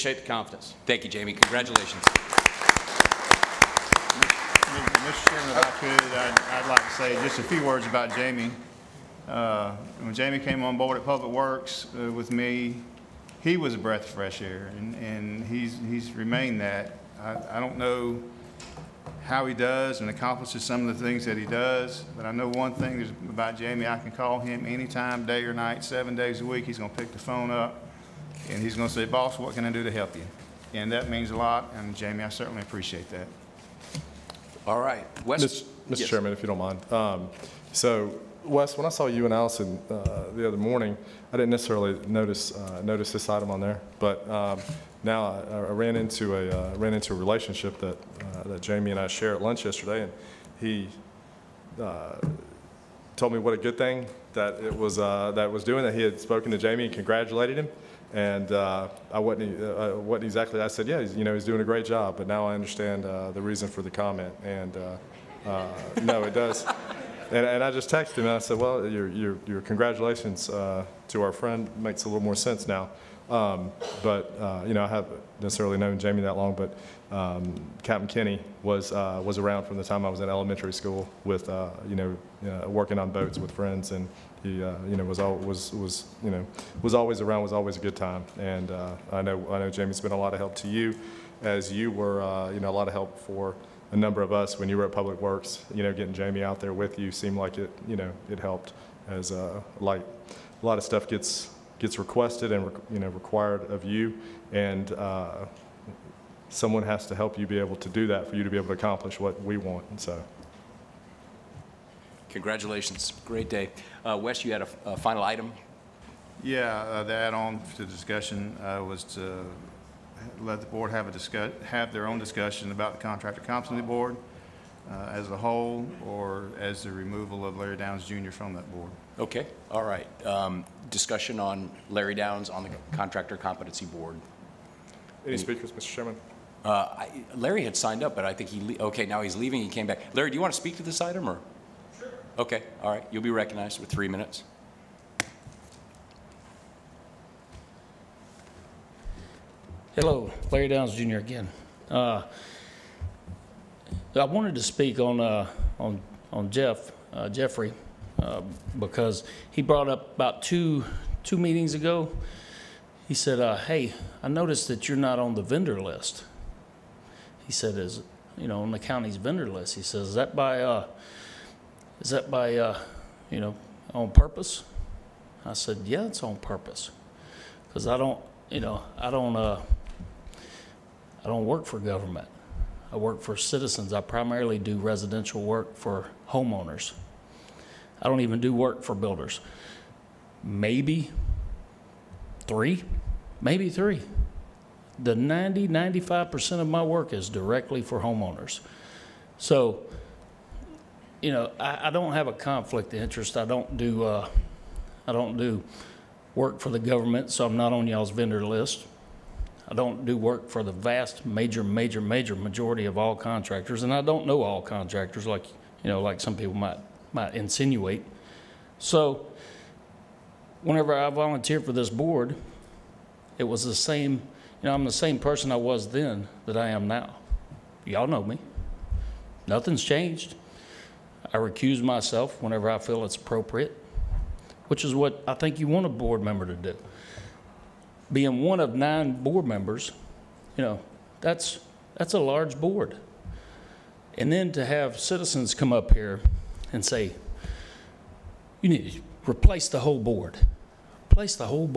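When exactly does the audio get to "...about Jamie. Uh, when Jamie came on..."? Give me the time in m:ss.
0:07.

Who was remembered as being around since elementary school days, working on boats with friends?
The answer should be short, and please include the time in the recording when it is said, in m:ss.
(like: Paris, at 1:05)
Captain Kenny, at 1:17.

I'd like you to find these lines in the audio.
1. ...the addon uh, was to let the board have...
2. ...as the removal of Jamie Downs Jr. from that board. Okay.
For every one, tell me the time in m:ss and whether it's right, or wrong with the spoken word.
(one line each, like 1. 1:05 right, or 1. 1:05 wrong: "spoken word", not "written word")
1. 1:57 wrong: "discussion", not "addon"
2. 2:06 wrong: "Larry", not "Jamie".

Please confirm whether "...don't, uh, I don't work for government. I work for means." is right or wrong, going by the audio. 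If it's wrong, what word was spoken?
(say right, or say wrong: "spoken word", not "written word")
wrong: "citizens", not "means".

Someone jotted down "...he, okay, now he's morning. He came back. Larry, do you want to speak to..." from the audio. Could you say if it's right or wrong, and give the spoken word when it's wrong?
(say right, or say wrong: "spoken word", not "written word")
wrong: "leaving", not "morning".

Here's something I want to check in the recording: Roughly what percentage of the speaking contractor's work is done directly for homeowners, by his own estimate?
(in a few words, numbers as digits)
95%.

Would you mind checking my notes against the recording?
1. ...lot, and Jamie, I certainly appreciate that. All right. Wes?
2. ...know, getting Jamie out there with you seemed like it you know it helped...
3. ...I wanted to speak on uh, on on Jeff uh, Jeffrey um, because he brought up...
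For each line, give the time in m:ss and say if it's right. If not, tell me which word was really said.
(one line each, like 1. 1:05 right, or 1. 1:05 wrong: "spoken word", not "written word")
1. 0:31 right
2. 1:35 right
3. 2:34 right.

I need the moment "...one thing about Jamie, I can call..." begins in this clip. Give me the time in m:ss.
0:22.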